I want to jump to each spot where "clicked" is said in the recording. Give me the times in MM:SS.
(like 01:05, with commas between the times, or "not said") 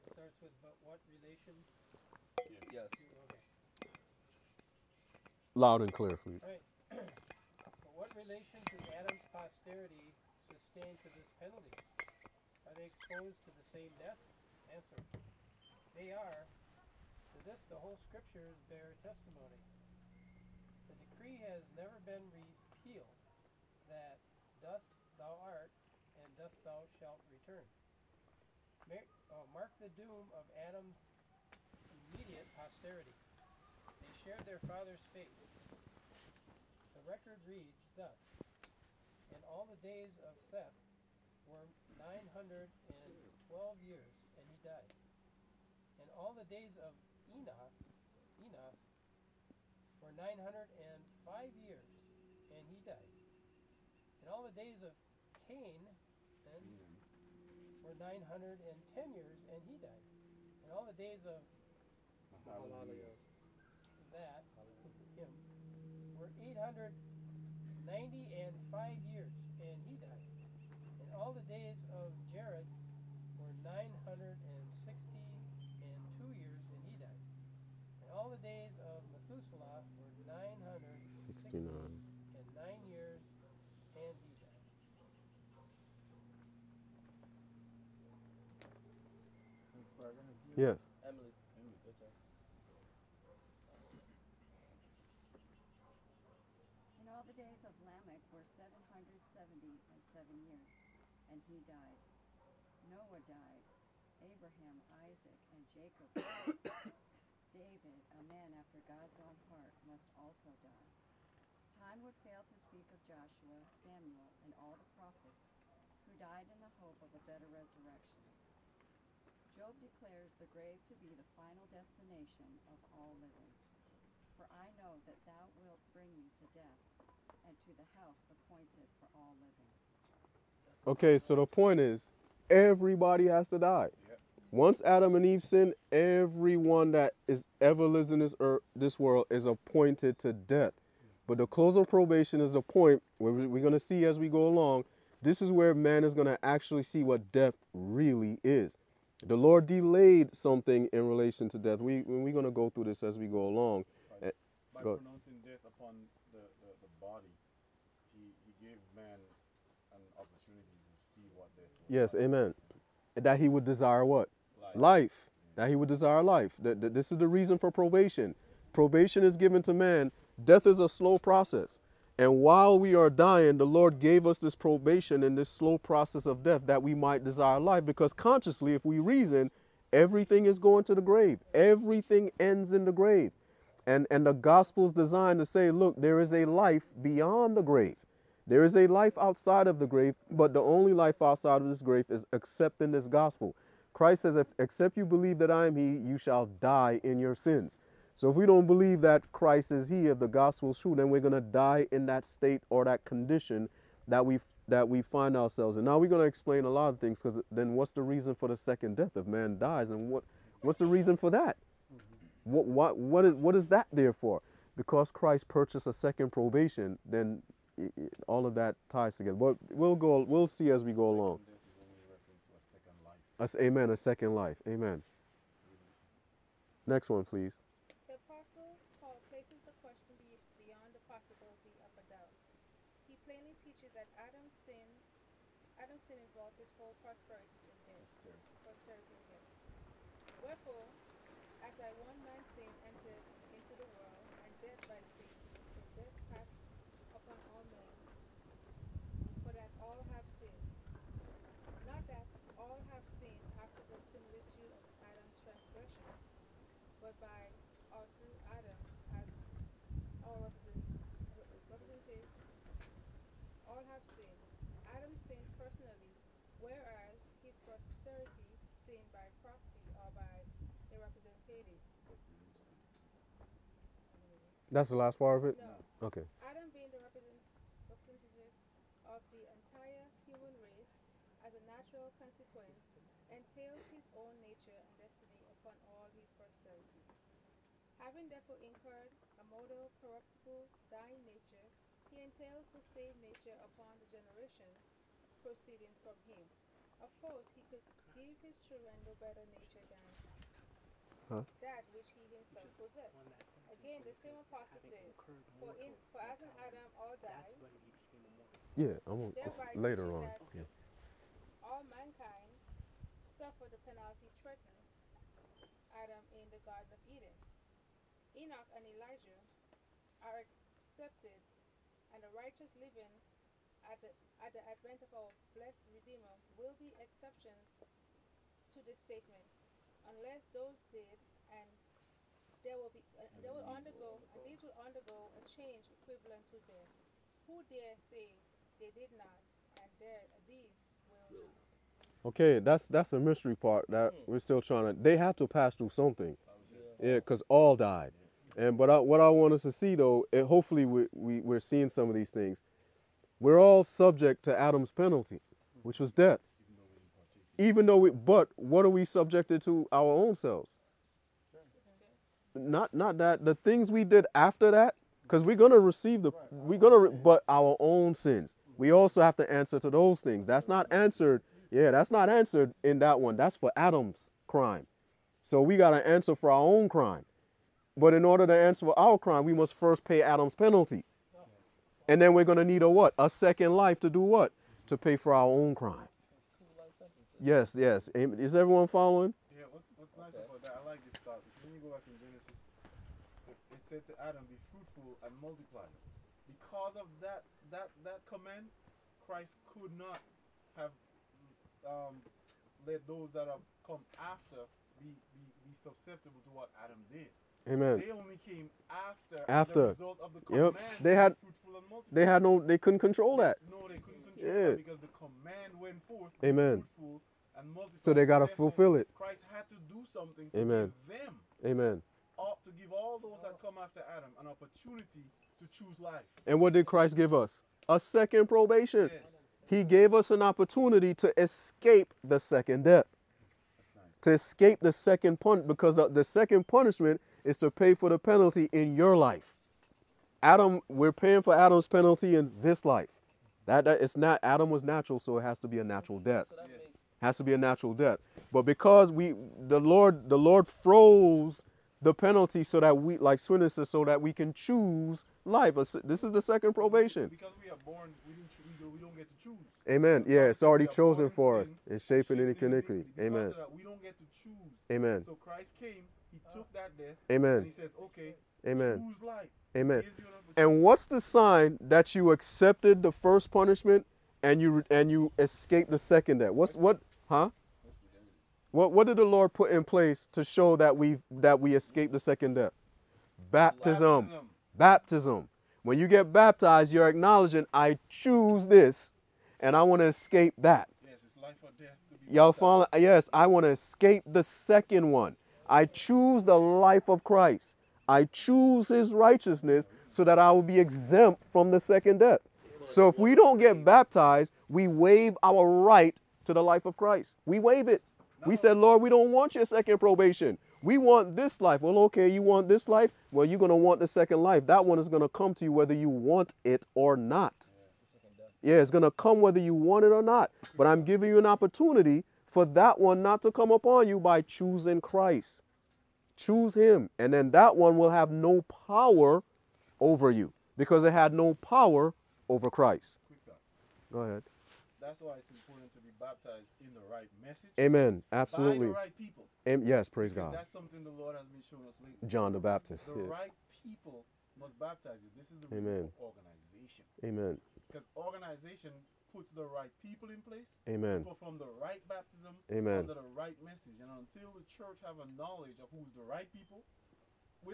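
not said.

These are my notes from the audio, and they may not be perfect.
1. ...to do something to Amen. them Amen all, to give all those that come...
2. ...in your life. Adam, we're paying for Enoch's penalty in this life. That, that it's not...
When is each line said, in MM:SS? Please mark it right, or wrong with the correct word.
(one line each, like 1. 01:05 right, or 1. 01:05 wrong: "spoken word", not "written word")
1. 06:59 right
2. 07:18 wrong: "Adam", not "Enoch".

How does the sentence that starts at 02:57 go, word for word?
Because consciously, if we reason, everything is going to the grave.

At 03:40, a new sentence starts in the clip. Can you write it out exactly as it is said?
We'll see as we go along.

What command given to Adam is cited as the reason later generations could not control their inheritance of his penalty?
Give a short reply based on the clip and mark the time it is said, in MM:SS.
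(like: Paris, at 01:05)
Be fruitful and multiply, at 06:34.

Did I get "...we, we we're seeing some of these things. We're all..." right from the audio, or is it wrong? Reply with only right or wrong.
right.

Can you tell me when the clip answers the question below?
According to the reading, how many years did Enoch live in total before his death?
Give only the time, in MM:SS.
00:50.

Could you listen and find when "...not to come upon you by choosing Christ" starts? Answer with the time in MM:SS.
08:43.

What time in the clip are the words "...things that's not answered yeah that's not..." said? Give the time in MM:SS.
06:10.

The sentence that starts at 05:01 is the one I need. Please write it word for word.
that which he himself possessed again, the same processes.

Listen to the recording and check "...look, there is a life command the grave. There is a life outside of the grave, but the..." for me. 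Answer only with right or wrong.
wrong.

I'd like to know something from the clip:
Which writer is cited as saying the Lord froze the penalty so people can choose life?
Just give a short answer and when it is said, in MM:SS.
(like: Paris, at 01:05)
Swinton, at 07:33.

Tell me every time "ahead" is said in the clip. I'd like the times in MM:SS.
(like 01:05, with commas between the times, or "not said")
08:54.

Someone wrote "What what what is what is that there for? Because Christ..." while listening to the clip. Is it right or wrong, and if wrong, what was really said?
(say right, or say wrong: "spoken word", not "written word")
right.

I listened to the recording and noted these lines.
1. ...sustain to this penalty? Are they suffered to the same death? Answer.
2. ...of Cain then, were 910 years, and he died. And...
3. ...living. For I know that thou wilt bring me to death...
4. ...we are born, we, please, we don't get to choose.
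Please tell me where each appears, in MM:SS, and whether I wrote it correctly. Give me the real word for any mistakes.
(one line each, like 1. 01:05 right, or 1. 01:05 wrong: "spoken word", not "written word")
1. 00:10 wrong: "exposed", not "suffered"
2. 00:54 right
3. 02:03 right
4. 07:37 wrong: "choose", not "please".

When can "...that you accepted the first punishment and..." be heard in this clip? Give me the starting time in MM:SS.
07:51.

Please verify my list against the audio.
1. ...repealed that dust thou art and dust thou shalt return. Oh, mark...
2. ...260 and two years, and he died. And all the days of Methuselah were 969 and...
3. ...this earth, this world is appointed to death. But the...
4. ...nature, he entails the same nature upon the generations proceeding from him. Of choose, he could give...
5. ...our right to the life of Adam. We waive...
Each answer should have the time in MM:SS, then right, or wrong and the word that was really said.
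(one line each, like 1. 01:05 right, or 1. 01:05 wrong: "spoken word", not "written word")
1. 00:22 right
2. 01:13 wrong: "960", not "260"
3. 02:18 right
4. 04:51 wrong: "course", not "choose"
5. 08:25 wrong: "Christ", not "Adam".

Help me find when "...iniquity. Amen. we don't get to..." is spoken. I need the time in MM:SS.
07:42.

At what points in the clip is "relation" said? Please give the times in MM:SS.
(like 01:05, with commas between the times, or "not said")
00:08, 02:31.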